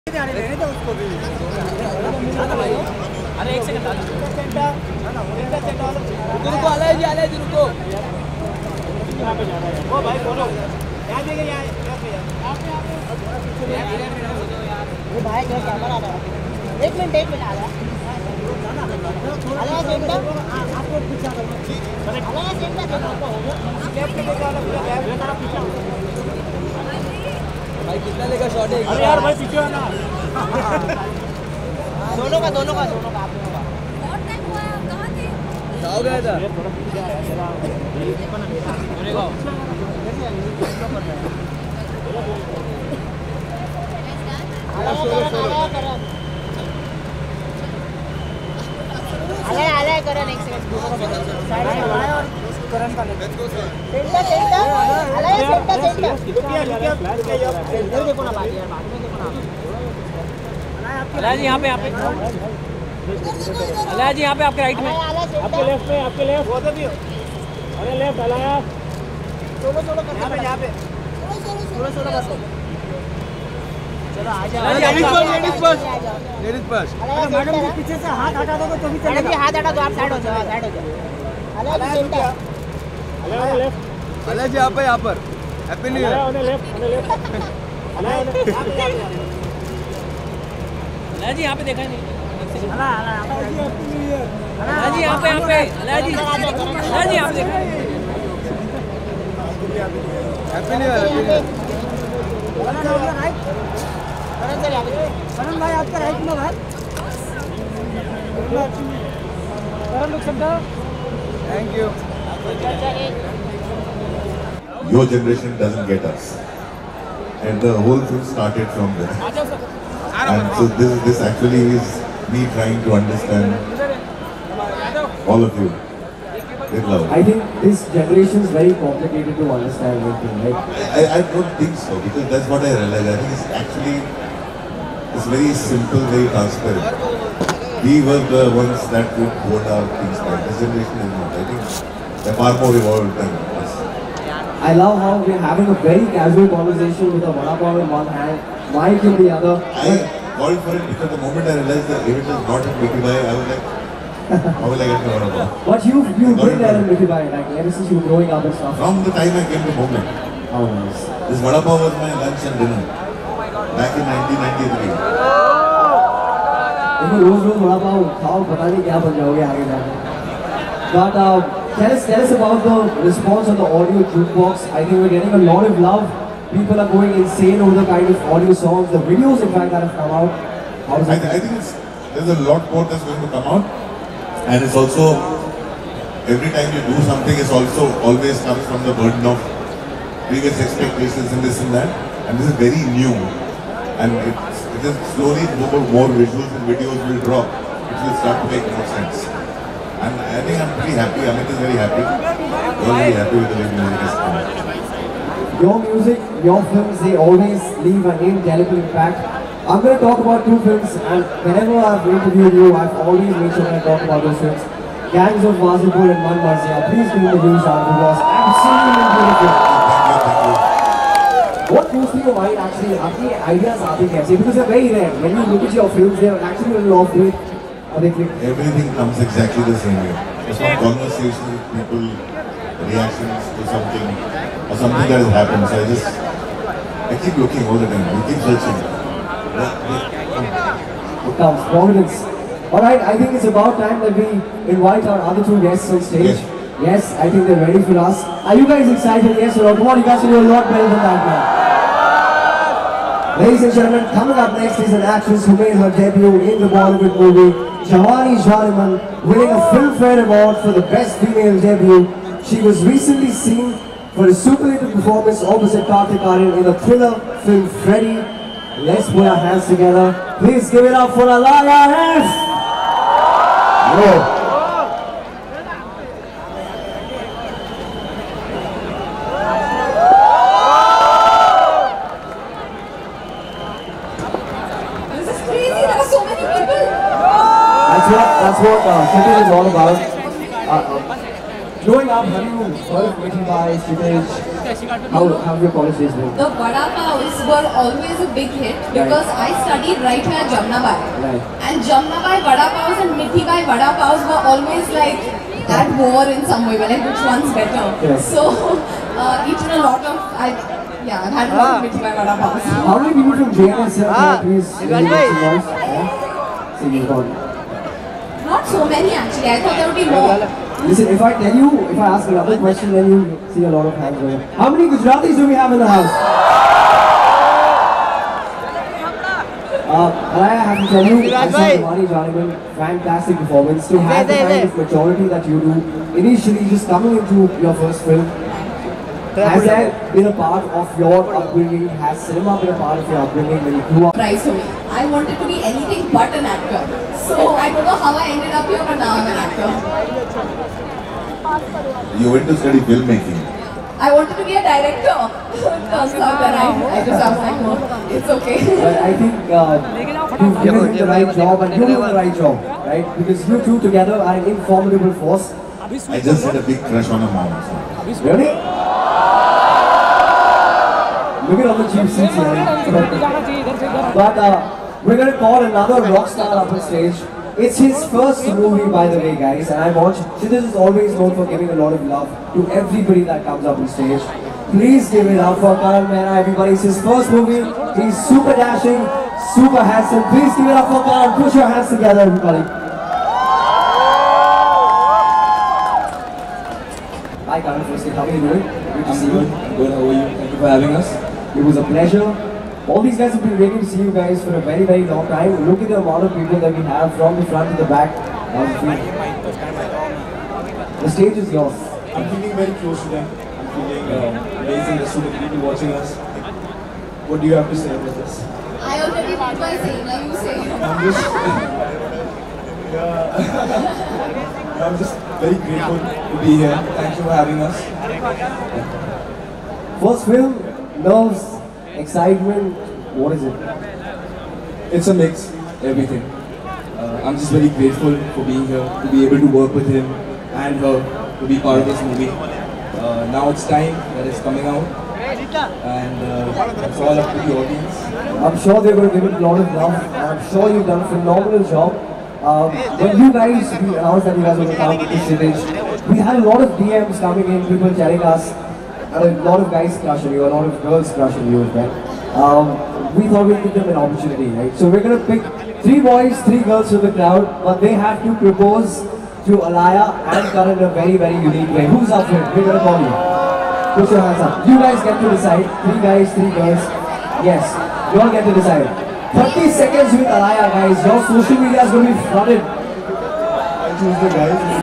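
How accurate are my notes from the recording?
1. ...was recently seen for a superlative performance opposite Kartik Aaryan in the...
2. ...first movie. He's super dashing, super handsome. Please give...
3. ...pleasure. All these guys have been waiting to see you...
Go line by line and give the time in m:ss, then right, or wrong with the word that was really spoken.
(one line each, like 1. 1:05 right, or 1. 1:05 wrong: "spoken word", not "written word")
1. 4:22 right
2. 6:27 right
3. 6:41 right.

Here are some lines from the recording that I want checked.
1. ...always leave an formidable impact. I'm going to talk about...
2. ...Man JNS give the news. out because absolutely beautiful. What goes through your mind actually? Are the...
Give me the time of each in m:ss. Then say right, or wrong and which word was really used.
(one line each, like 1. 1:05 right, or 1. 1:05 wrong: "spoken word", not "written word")
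1. 3:27 wrong: "indelible", not "formidable"
2. 3:36 wrong: "Please", not "JNS".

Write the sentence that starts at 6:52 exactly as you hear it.
I'm feeling very close to them.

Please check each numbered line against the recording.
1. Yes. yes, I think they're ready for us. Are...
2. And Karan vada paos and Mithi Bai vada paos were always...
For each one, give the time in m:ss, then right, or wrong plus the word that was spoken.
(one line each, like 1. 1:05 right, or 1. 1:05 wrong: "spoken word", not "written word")
1. 4:06 right
2. 5:01 wrong: "Jamnabai", not "Karan".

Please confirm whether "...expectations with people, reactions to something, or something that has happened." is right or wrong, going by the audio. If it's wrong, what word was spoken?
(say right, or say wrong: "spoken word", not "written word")
wrong: "conversations", not "expectations".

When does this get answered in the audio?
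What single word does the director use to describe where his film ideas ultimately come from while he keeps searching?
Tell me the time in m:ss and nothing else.
4:01.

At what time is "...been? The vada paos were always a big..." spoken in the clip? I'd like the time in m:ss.
4:56.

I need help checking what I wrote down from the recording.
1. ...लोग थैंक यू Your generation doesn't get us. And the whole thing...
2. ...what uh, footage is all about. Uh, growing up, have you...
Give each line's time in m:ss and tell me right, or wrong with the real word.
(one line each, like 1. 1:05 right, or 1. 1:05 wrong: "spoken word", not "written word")
1. 1:48 right
2. 4:48 right.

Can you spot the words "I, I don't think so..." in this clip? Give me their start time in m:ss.
2:10.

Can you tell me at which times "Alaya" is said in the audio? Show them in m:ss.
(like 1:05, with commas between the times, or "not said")
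4:31, 7:49, 8:00.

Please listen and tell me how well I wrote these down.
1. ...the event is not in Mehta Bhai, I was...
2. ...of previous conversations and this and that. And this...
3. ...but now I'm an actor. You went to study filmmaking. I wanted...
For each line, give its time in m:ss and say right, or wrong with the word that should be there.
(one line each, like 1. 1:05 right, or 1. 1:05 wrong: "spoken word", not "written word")
1. 2:31 wrong: "Mickey", not "Mehta"
2. 3:09 wrong: "expectations", not "conversations"
3. 5:48 right.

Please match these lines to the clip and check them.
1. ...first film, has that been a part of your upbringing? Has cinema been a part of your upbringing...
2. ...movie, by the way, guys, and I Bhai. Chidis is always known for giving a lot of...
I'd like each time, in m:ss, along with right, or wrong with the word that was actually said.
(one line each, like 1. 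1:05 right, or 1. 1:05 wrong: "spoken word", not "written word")
1. 5:37 right
2. 6:18 wrong: "She", not "Bhai".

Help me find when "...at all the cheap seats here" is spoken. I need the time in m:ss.
6:11.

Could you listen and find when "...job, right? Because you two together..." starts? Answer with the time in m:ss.
6:02.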